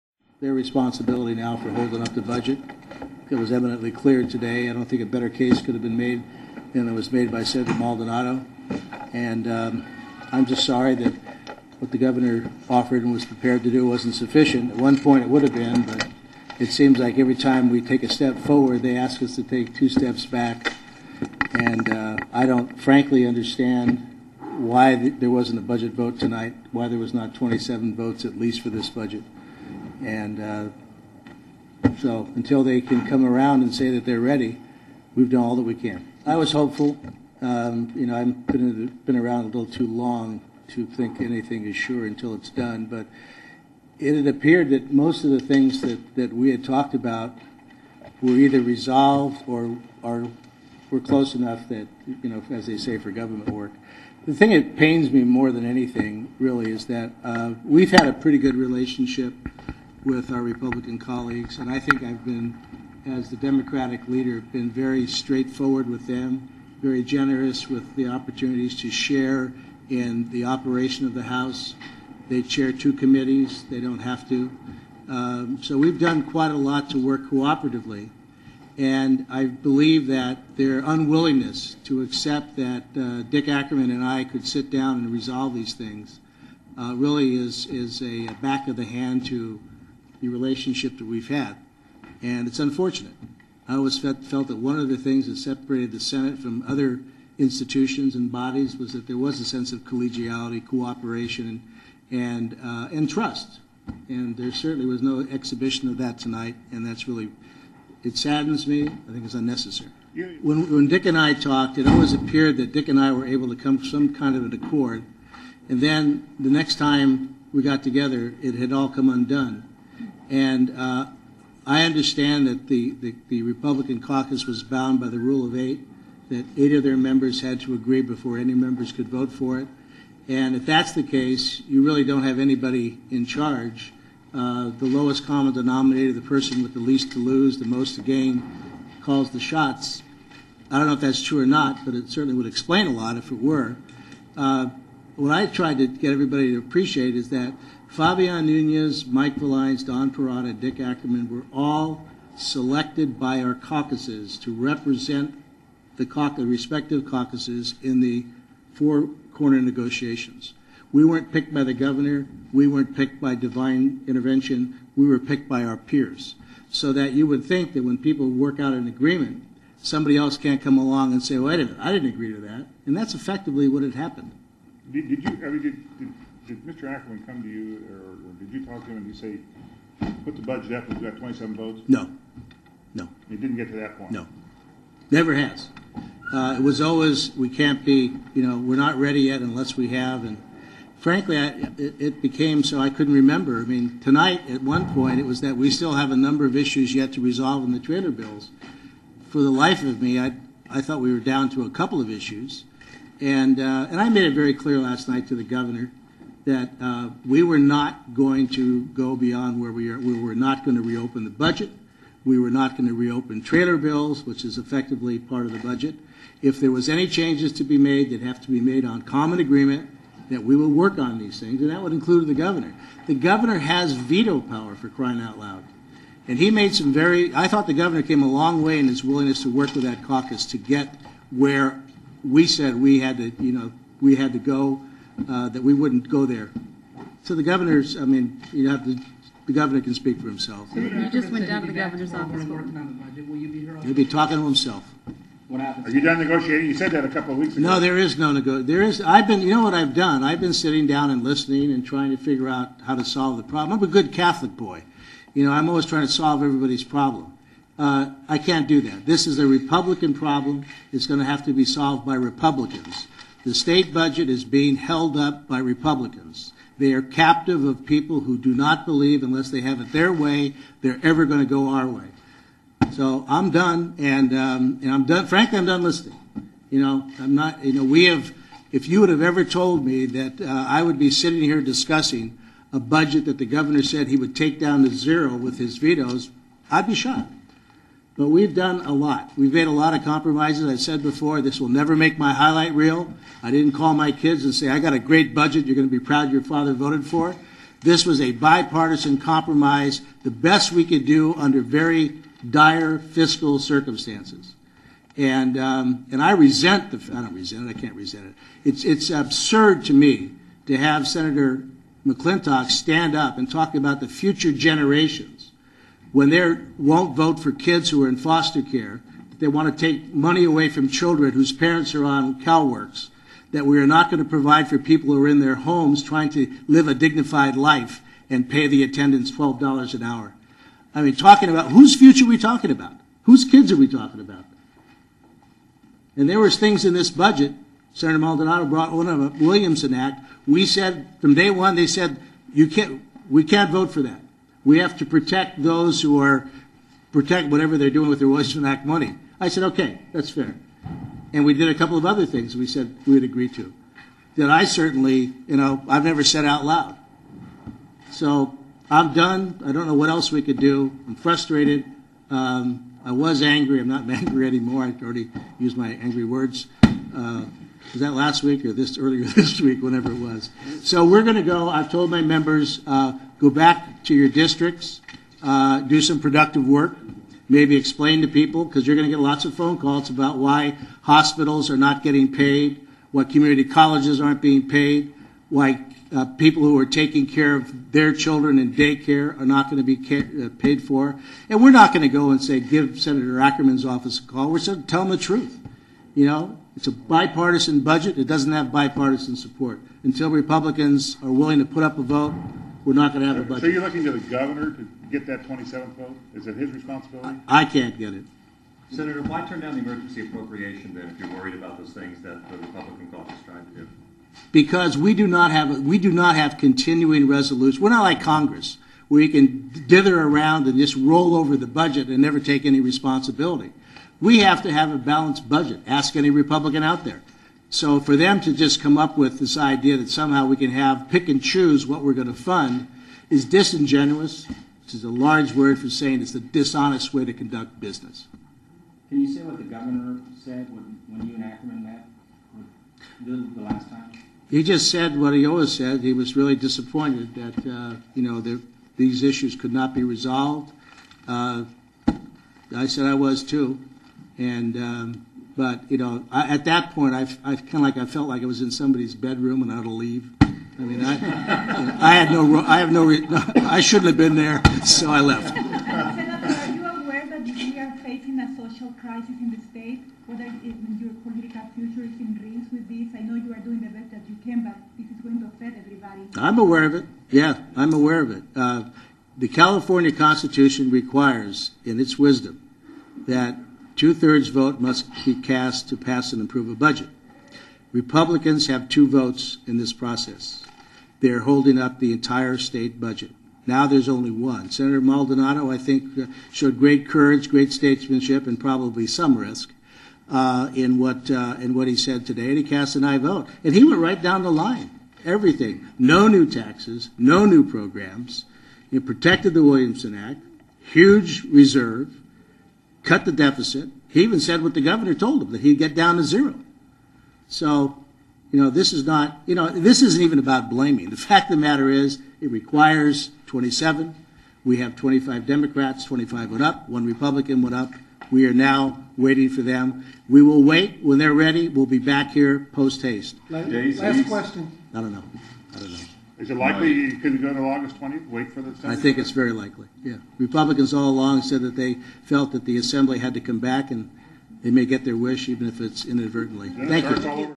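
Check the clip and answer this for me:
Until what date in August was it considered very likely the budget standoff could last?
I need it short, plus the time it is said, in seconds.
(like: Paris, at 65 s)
August 20th, at 537 s.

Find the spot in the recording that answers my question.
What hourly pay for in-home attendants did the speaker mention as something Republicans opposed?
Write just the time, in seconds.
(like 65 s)
329 s.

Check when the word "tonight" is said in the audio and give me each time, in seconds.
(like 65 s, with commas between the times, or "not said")
26 s, 106 s, 193 s.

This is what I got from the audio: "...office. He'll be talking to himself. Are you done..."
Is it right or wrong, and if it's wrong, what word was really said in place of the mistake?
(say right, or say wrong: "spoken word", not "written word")
right.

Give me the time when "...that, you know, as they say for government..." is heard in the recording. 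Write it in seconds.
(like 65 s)
51 s.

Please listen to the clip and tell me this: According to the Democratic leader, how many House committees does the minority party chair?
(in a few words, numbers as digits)
2.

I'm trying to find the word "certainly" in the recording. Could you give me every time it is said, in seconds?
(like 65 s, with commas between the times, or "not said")
104 s, 142 s, 354 s.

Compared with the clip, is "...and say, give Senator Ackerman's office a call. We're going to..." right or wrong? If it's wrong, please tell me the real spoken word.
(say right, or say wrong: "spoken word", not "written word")
right.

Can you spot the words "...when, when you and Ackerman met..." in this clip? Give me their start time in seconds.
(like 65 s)
440 s.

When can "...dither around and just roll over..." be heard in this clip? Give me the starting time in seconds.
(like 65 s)
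419 s.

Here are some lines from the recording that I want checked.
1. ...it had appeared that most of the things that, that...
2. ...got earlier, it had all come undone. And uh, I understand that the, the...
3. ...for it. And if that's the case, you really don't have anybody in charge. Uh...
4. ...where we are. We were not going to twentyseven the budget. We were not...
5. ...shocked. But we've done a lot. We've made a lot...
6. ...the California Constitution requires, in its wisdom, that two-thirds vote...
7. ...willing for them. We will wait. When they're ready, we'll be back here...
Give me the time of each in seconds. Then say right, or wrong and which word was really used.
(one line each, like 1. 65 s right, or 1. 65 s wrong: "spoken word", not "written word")
1. 43 s right
2. 117 s wrong: "together", not "earlier"
3. 129 s right
4. 209 s wrong: "reopen", not "twentyseven"
5. 286 s right
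6. 479 s right
7. 529 s wrong: "waiting", not "willing".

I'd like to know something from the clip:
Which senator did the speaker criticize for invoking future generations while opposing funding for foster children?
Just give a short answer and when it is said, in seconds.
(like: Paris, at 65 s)
Senator McClintock, at 311 s.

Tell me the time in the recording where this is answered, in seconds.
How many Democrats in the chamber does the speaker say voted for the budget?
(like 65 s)
524 s.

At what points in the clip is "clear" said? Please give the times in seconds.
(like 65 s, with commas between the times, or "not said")
3 s, 204 s.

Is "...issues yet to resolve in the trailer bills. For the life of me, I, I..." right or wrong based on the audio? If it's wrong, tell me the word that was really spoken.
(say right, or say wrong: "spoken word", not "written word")
right.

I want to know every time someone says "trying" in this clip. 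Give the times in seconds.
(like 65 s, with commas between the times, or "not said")
251 s, 255 s, 326 s, 413 s.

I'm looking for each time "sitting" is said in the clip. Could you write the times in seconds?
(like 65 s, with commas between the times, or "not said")
250 s, 281 s.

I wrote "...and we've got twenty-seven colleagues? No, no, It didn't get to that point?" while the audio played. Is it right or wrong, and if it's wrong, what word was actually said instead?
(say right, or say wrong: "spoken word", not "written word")
wrong: "votes", not "colleagues".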